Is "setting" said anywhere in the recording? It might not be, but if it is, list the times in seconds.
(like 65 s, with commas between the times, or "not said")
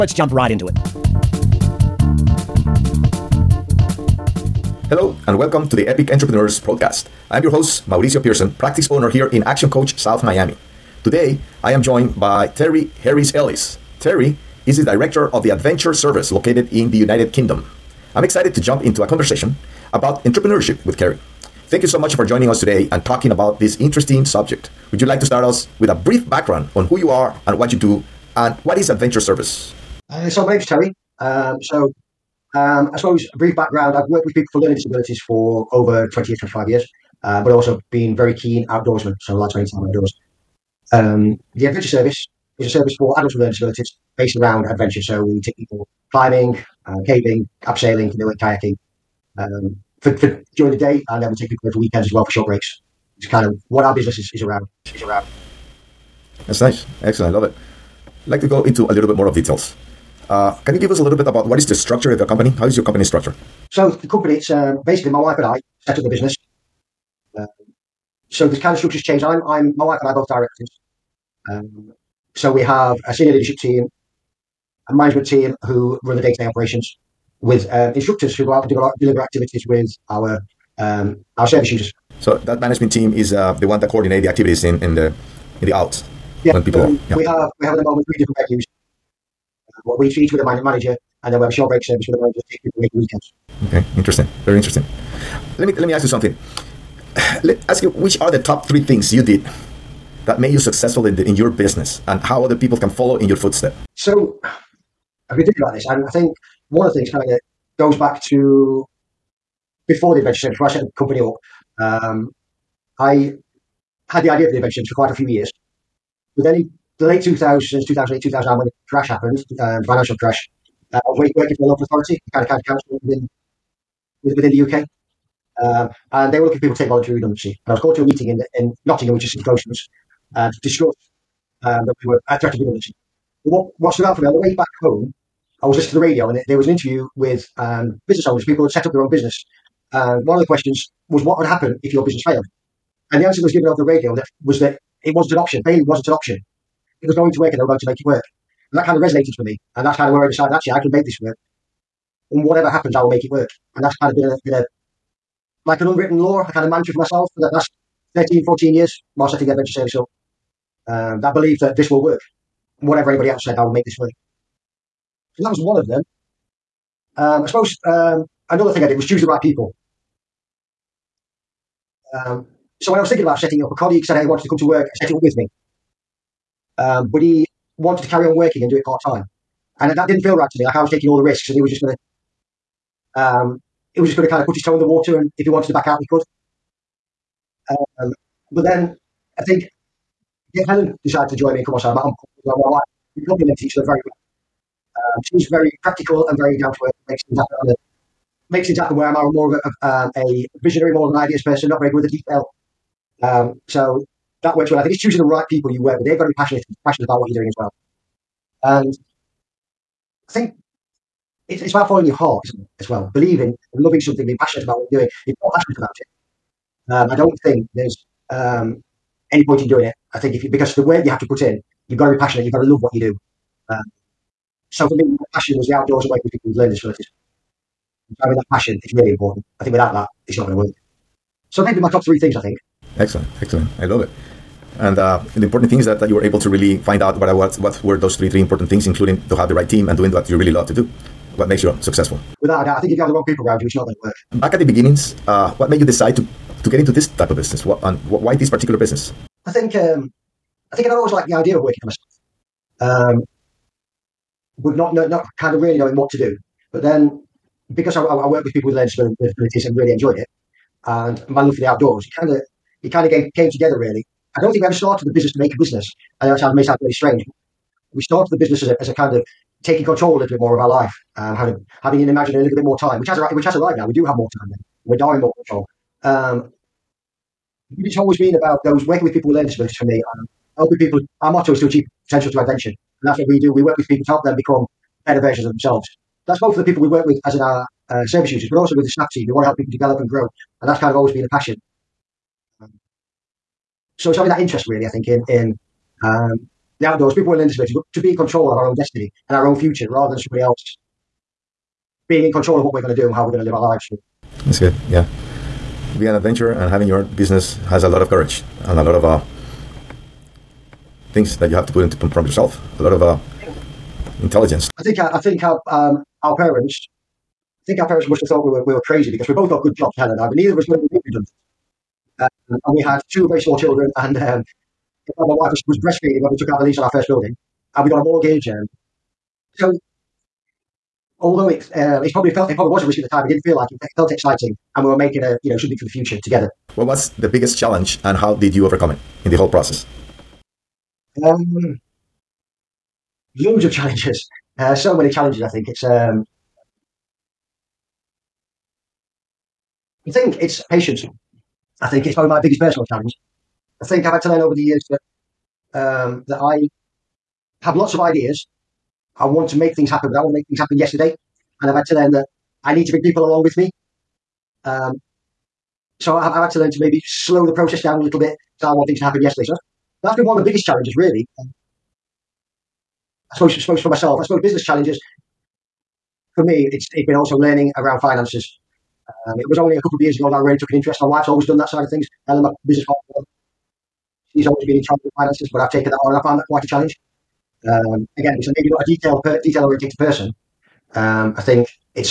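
159 s, 173 s.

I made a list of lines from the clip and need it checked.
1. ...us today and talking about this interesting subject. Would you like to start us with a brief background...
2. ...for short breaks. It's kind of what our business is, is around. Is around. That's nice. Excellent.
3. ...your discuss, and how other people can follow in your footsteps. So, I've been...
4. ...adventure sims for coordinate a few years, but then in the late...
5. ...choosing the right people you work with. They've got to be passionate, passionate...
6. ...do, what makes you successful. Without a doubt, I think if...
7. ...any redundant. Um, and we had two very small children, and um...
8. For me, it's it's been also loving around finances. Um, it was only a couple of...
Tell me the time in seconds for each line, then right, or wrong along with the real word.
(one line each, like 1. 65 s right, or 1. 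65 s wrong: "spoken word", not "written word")
1. 22 s right
2. 52 s right
3. 101 s wrong: "business", not "discuss"
4. 114 s wrong: "quite", not "coordinate"
5. 204 s right
6. 240 s right
7. 320 s right
8. 376 s wrong: "learning", not "loving".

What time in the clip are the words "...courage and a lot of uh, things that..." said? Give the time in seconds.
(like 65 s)
308 s.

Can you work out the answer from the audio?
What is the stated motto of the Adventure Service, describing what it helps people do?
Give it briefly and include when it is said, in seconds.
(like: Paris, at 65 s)
Achieve potential through adventure, at 281 s.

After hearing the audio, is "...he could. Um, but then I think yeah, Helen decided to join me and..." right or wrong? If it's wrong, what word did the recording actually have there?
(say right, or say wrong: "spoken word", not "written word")
right.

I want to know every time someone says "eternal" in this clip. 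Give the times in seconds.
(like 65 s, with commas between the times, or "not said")
not said.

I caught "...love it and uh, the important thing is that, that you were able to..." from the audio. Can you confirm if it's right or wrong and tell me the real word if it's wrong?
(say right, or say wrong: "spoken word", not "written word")
right.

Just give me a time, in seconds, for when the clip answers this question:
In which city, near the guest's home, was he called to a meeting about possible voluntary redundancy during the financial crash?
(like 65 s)
128 s.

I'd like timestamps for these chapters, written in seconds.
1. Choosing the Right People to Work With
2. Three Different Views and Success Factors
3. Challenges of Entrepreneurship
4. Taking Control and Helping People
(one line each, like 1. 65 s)
1. 178 s
2. 86 s
3. 356 s
4. 266 s.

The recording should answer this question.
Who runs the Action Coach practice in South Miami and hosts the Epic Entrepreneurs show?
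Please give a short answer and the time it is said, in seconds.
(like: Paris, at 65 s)
Mauricio Pierson, at 7 s.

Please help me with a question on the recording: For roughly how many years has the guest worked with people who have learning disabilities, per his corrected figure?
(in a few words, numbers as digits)
25 years.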